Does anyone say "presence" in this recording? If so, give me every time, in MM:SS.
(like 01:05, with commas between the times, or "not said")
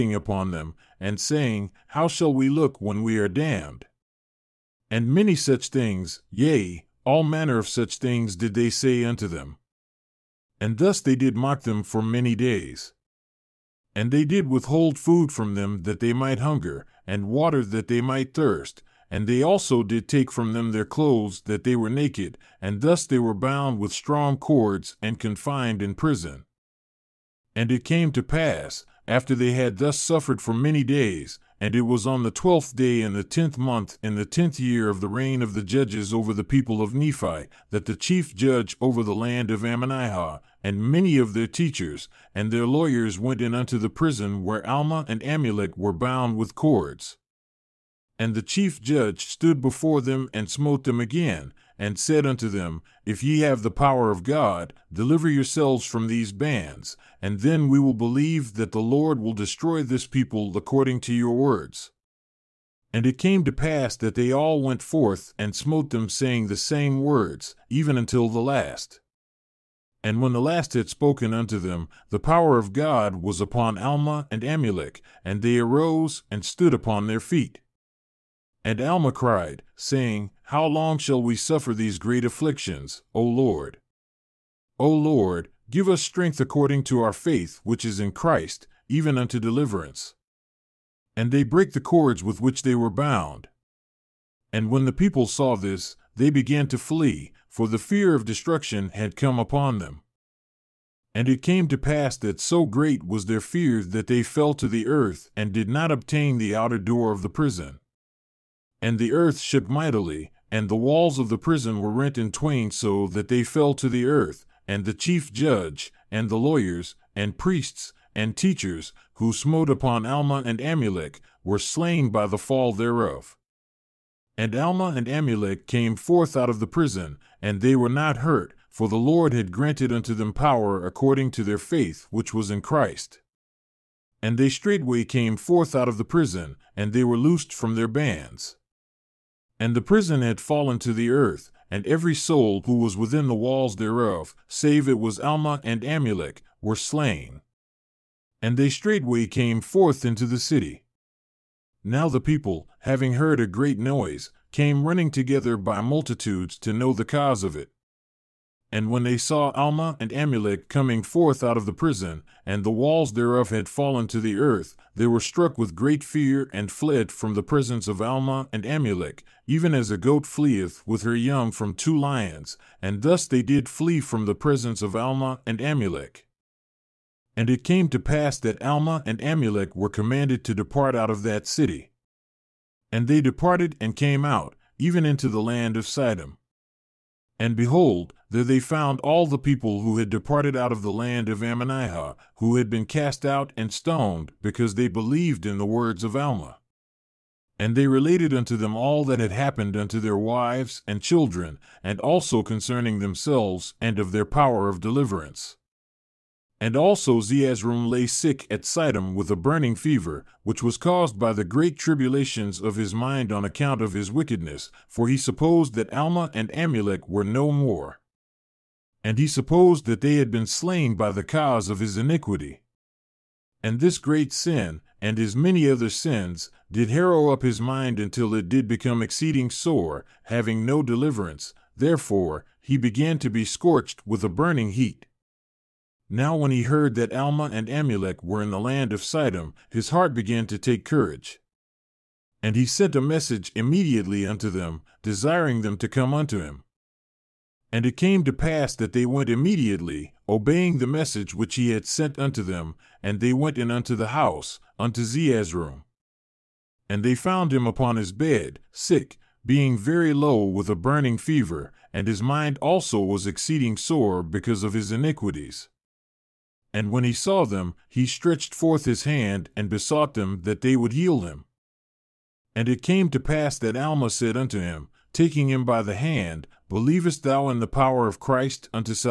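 02:47, 02:54.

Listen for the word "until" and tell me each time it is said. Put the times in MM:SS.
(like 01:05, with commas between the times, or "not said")
01:07, 03:47.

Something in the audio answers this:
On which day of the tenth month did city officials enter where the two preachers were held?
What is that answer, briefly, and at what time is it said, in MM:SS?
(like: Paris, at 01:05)
12th, at 00:32.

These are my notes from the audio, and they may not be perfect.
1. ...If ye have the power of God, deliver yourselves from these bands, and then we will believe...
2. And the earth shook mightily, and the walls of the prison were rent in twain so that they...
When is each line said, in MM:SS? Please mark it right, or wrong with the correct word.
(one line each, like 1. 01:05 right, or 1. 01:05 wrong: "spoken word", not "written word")
1. 00:53 right
2. 01:48 right.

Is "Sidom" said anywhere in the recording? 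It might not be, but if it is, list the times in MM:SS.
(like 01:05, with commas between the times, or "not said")
03:05, 03:28, 03:59.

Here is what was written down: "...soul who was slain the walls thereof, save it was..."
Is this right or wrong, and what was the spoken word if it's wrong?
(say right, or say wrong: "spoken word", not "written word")
wrong: "within", not "slain".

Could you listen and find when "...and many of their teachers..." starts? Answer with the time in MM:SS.
00:40.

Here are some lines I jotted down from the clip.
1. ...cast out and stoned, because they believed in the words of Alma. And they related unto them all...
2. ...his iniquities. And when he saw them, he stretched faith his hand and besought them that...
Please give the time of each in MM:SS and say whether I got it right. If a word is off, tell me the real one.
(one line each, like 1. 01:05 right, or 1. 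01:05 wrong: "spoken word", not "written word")
1. 03:12 right
2. 04:24 wrong: "forth", not "faith".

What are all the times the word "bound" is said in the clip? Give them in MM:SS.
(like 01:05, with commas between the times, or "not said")
00:23, 00:45, 01:32.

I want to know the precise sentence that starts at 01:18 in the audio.
And Alma cried, saying, How long shall we suffer these great afflictions, O Lord?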